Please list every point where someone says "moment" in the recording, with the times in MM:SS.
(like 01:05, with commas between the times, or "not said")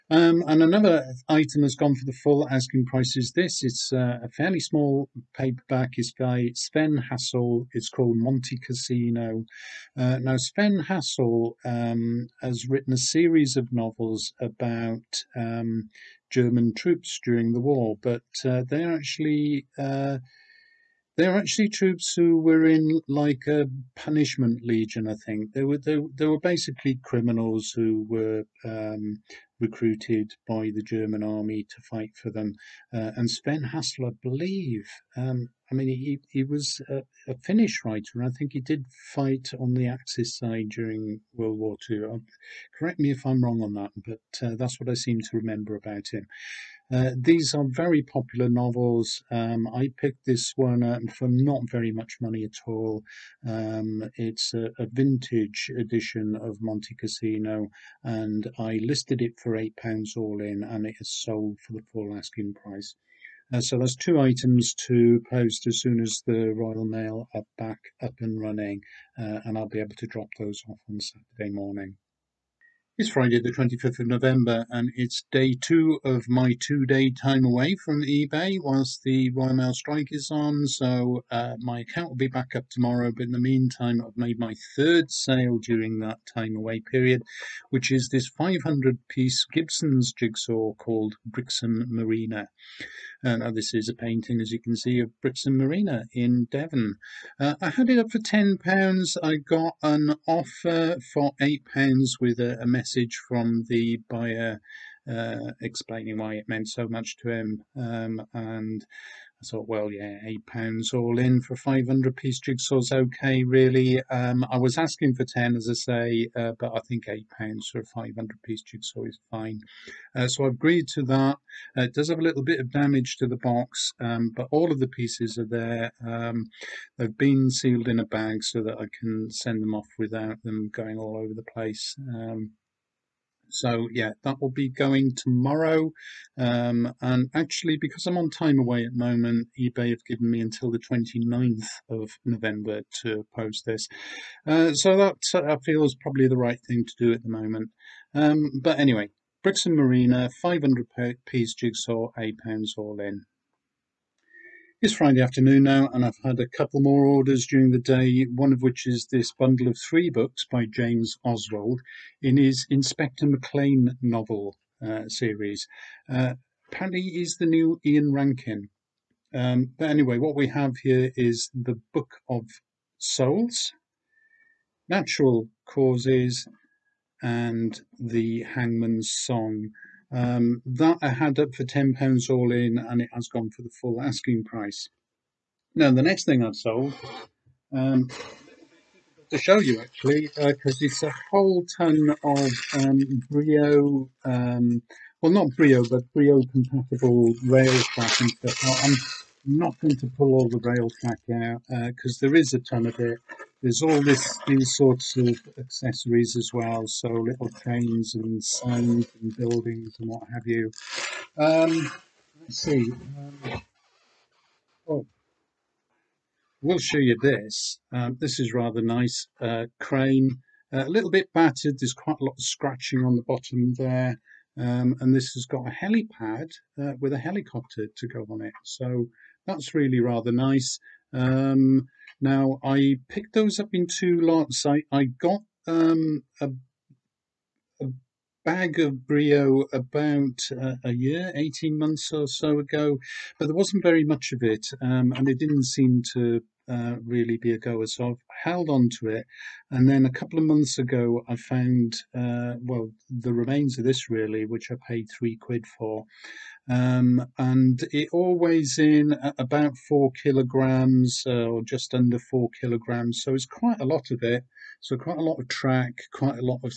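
02:19, 02:27.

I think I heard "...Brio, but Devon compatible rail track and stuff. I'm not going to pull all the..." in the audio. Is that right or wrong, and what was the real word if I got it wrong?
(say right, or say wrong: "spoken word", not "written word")
wrong: "Brio", not "Devon".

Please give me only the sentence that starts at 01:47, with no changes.
Um, and I thought, well, yeah, eight pounds all in for 500 piece jigsaw's okay, really.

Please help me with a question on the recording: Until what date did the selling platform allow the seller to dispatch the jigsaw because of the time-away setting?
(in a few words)
29th of November.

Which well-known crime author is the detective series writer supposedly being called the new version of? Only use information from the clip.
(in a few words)
Ian Rankin.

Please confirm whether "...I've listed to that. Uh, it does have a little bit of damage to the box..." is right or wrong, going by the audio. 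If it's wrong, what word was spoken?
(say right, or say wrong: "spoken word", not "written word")
wrong: "agreed", not "listed".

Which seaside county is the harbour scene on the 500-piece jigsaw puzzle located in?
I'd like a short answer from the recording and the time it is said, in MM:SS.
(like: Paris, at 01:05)
Devon, at 01:36.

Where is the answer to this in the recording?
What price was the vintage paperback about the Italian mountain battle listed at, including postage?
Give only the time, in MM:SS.
00:59.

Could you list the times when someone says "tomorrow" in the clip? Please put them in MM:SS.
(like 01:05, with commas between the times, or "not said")
01:22, 02:15.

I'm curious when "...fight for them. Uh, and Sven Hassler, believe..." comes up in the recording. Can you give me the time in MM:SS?
00:31.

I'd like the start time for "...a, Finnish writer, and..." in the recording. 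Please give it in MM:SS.
00:37.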